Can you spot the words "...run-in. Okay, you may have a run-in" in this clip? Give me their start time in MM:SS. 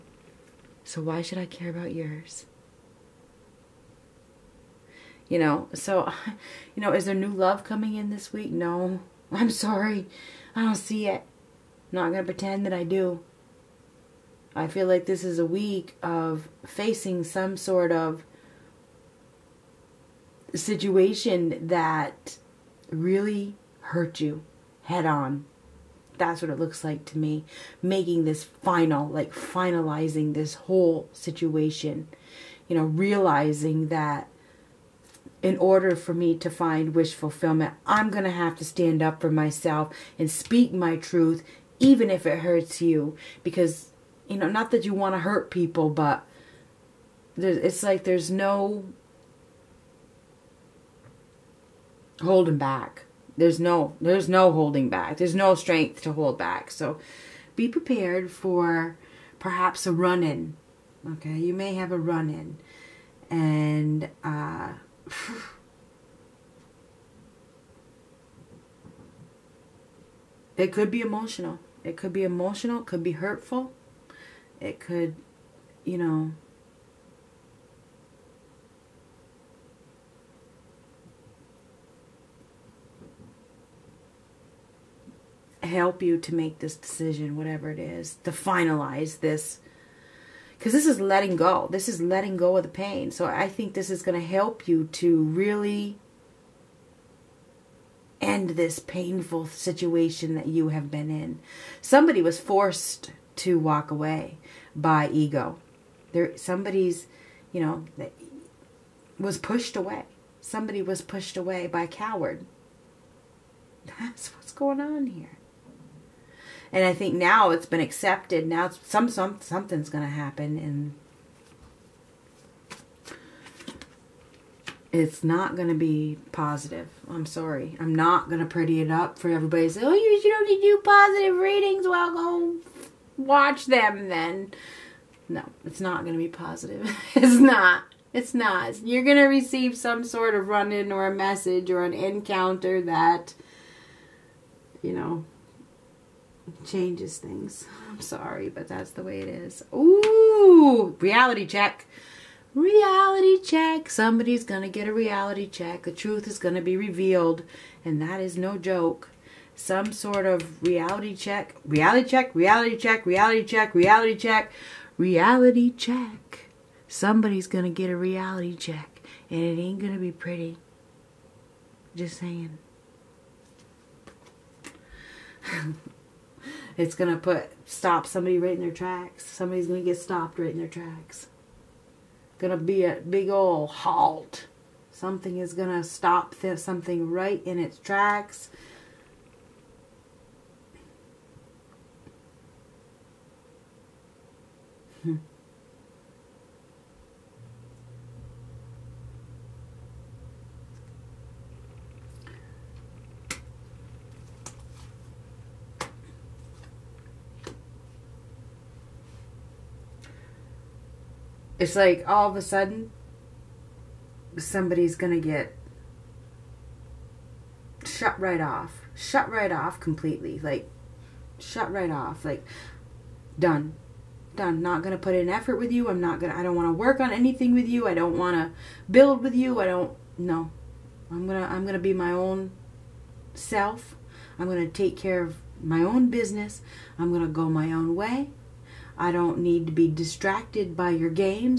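00:59.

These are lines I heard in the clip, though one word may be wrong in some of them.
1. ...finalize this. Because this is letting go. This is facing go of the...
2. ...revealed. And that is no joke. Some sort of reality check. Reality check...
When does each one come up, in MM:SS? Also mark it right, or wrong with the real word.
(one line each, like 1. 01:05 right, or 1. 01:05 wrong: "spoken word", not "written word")
1. 01:28 wrong: "letting", not "facing"
2. 02:36 right.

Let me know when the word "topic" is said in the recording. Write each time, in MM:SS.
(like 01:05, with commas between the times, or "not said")
not said.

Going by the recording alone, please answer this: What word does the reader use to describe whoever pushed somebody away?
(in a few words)
coward.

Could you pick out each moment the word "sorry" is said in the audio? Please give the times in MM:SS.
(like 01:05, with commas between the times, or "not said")
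00:09, 02:07, 02:28.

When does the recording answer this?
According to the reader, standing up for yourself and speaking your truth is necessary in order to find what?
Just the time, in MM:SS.
00:36.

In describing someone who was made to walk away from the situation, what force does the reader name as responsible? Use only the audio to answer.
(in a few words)
ego.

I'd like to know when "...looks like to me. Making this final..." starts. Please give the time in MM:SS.
00:26.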